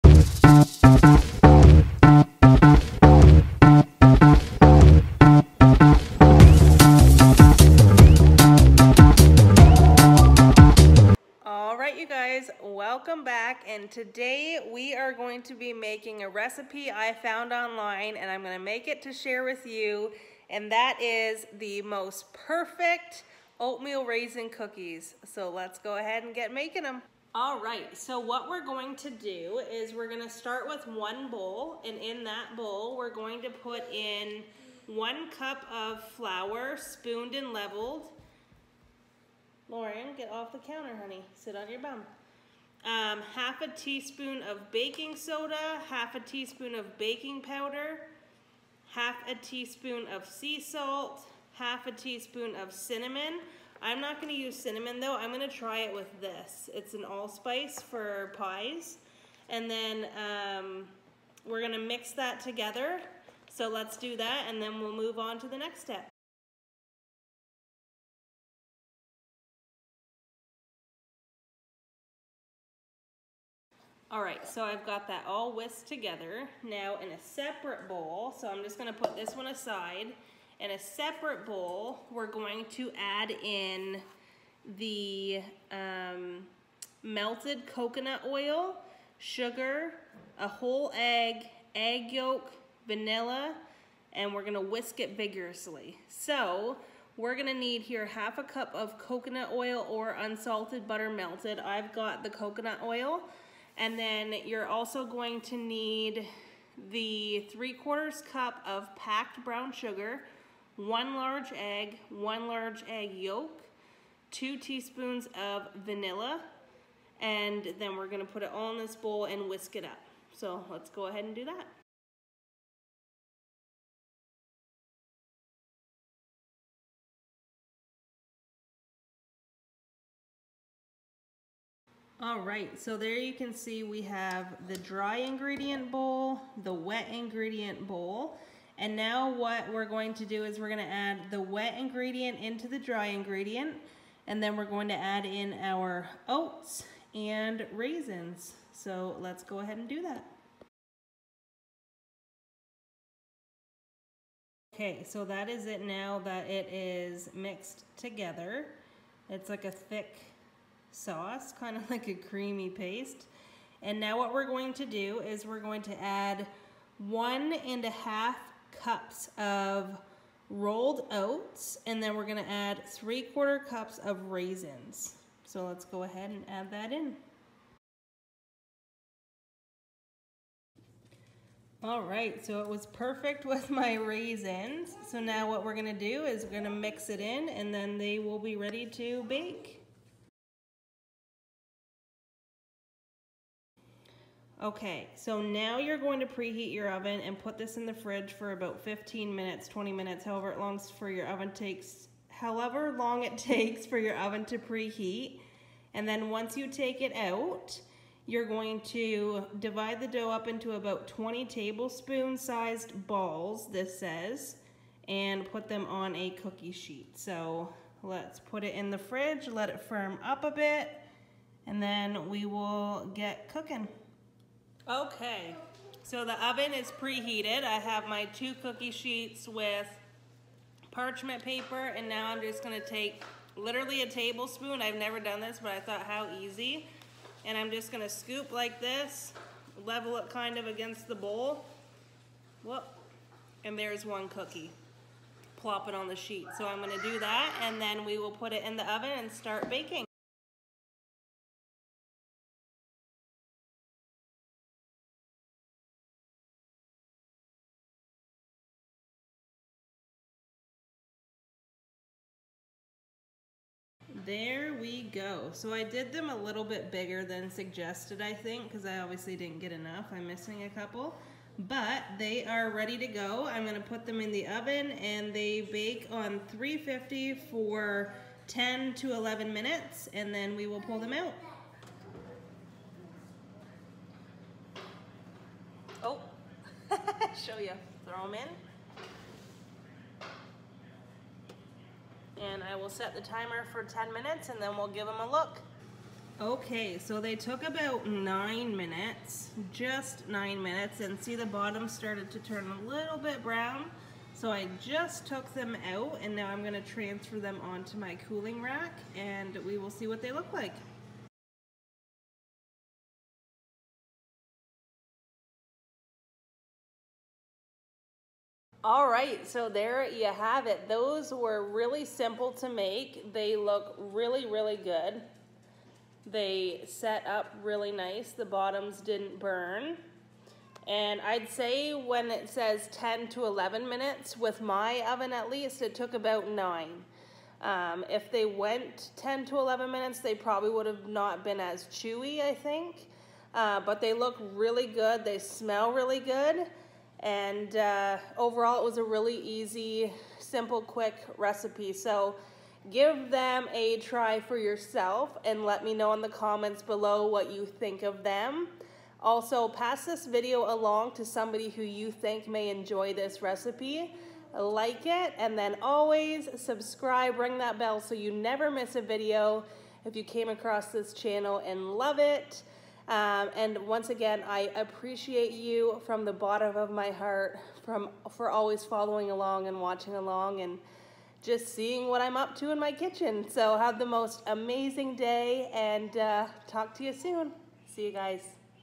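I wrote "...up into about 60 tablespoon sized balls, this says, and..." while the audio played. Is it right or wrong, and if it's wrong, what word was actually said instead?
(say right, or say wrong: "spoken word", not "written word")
wrong: "20", not "60".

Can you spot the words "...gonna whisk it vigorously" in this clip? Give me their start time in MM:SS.
01:34.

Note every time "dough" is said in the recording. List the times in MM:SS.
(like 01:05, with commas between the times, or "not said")
03:30.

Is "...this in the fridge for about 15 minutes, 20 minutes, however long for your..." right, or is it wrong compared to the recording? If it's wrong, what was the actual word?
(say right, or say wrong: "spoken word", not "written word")
right.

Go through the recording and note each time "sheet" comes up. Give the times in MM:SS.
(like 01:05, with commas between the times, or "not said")
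03:36, 03:48, 04:06.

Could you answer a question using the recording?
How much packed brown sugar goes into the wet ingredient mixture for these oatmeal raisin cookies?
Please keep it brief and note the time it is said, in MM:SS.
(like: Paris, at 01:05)
3/4 cup, at 01:47.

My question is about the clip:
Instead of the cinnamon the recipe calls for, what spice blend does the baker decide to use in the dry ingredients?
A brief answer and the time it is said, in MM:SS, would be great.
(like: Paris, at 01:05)
allspice for pies, at 00:57.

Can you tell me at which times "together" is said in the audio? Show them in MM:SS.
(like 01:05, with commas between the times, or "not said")
01:02, 01:15, 02:37.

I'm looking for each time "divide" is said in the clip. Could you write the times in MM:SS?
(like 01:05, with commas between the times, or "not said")
03:29.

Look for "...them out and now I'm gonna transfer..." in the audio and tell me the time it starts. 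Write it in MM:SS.
05:05.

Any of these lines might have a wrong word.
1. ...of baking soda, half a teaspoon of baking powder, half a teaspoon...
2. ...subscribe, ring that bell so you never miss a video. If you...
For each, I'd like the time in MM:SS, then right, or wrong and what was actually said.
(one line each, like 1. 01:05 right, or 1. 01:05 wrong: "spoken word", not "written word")
1. 00:44 right
2. 06:06 right.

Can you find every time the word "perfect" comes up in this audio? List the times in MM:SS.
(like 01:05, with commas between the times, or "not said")
00:22, 03:02.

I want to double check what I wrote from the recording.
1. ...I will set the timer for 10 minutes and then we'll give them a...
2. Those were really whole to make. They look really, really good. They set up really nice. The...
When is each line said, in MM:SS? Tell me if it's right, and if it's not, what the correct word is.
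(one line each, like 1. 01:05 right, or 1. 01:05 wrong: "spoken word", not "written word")
1. 04:52 right
2. 05:20 wrong: "simple", not "whole".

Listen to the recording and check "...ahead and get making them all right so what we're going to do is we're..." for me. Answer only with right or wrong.
right.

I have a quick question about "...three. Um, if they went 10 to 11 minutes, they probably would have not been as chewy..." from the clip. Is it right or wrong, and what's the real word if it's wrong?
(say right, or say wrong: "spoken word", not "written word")
wrong: "nine", not "three".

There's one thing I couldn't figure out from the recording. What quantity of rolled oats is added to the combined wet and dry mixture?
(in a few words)
1 1/2 cups.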